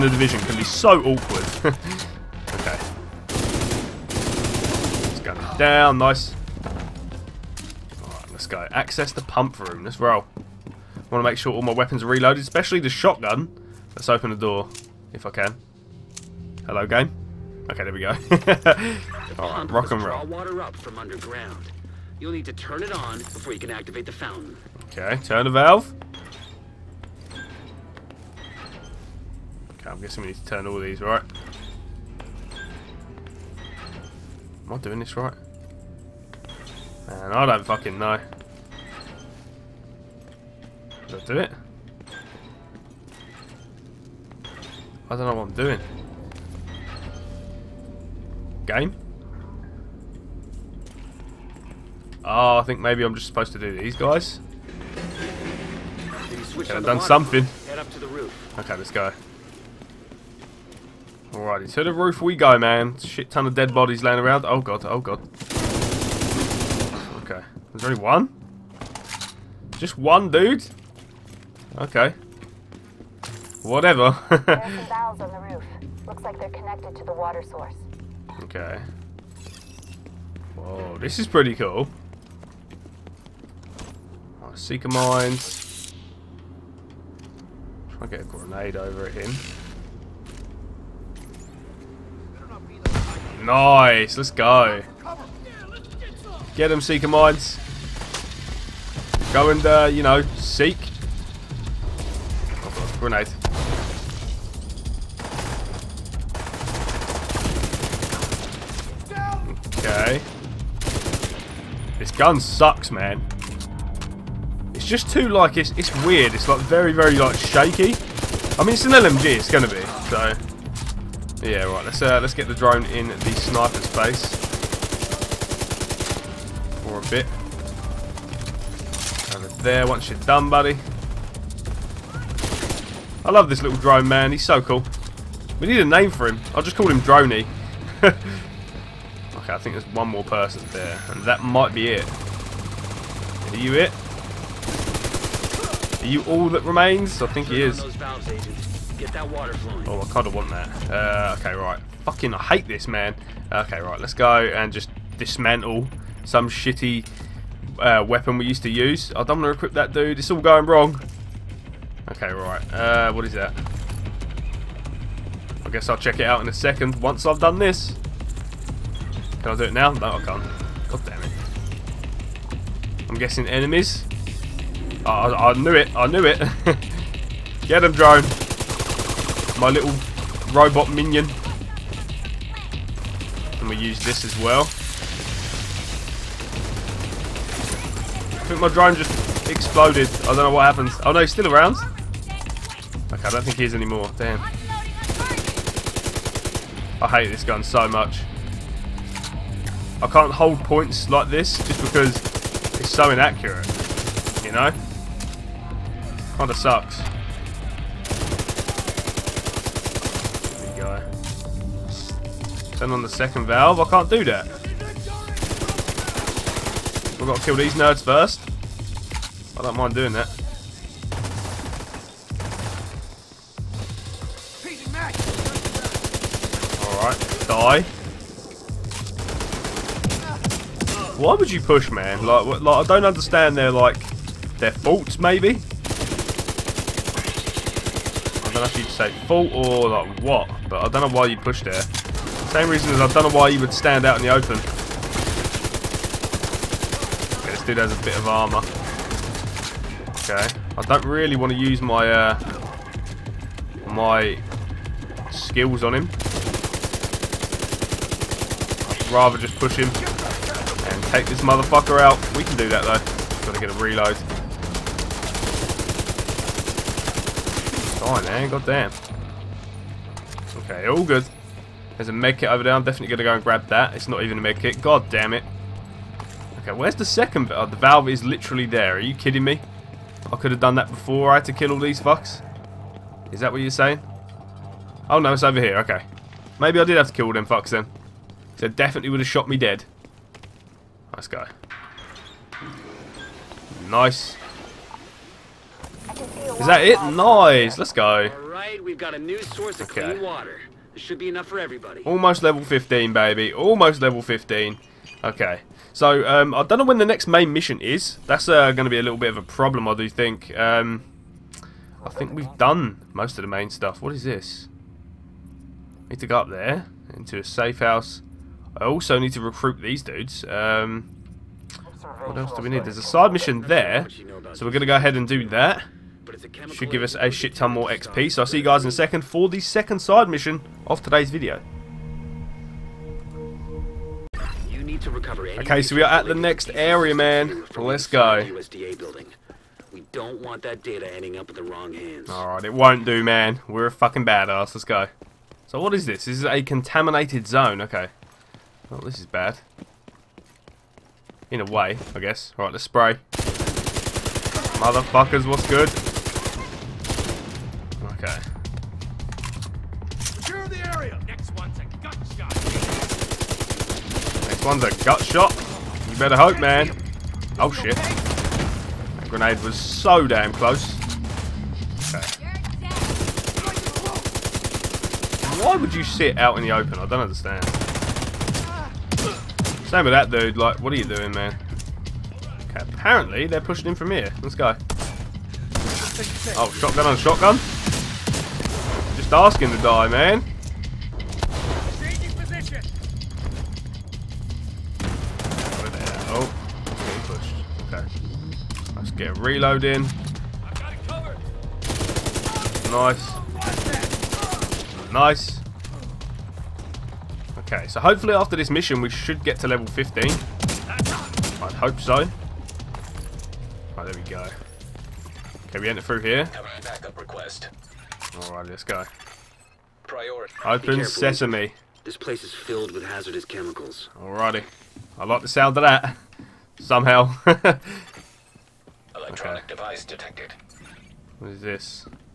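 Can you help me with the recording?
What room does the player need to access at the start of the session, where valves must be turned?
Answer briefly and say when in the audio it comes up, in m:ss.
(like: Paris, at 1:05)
Pump room, at 0:09.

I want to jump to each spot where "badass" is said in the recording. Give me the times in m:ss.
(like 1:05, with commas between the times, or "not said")
5:44.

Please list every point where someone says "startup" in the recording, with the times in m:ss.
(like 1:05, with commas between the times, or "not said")
not said.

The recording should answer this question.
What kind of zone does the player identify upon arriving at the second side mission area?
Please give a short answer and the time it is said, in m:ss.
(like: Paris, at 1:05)
Contaminated zone, at 5:46.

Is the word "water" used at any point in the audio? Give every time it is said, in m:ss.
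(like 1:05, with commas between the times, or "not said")
0:20, 1:17, 5:00.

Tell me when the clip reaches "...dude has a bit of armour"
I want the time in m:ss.
4:07.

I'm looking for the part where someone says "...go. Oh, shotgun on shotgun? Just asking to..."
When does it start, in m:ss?
6:24.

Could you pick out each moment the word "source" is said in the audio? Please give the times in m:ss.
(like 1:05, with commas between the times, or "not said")
1:17, 4:59.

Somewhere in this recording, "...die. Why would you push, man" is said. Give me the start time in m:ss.
3:51.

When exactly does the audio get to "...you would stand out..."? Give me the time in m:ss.
4:03.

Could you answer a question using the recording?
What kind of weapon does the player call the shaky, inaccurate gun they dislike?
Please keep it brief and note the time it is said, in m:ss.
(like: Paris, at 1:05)
LMG, at 1:58.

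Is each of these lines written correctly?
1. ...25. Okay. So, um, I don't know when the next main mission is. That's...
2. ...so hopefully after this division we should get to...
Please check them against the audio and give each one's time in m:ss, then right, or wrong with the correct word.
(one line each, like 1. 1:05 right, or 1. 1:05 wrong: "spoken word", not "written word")
1. 5:04 wrong: "15", not "25"
2. 6:47 wrong: "mission", not "division".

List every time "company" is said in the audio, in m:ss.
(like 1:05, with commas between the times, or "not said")
not said.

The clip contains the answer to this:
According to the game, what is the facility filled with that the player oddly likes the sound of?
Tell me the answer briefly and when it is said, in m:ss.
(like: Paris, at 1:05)
Hazardous chemicals, at 7:03.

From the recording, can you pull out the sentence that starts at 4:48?
So definitely would have shot me dead.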